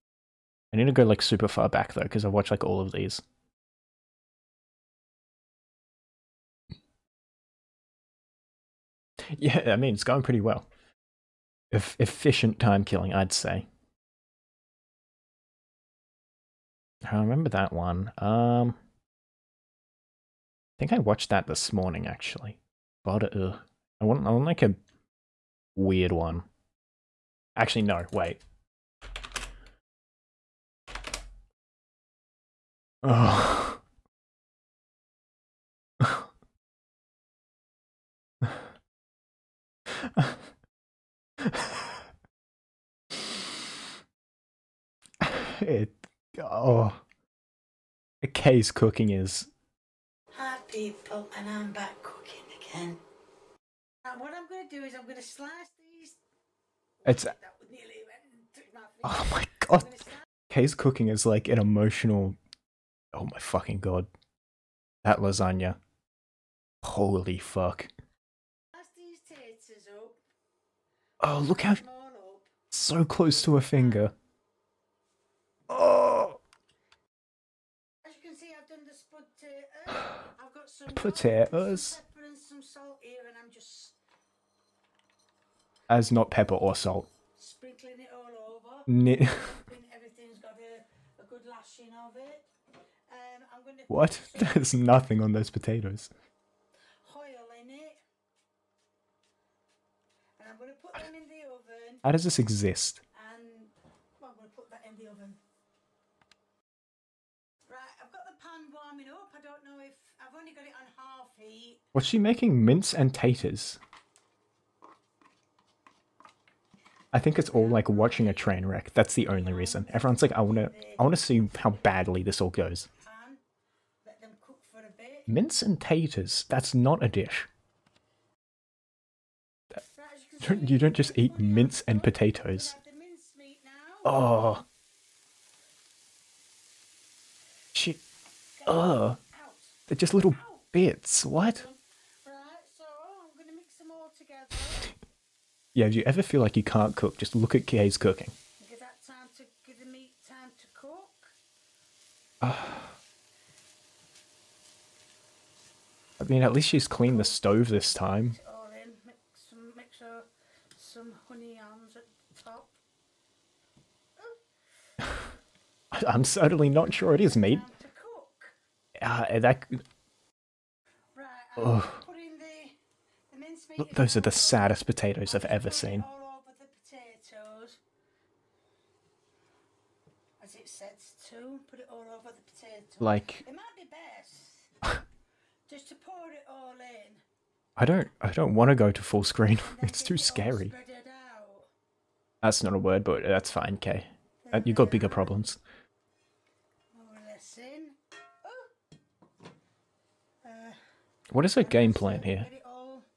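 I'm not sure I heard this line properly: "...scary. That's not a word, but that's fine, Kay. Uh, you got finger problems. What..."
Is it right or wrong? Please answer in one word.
wrong.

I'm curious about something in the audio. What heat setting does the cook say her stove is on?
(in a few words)
Half heat.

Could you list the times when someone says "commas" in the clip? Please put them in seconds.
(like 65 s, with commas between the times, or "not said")
not said.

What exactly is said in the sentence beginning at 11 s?
E efficient time killing, I'd say.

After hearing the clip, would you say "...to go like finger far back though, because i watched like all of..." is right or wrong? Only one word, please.
wrong.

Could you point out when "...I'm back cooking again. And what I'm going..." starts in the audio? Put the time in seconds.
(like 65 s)
51 s.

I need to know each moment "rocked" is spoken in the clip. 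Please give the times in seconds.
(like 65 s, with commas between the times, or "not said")
not said.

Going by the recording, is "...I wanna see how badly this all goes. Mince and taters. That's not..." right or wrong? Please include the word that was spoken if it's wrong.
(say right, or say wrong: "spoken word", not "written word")
right.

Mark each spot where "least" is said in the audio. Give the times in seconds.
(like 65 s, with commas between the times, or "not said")
156 s.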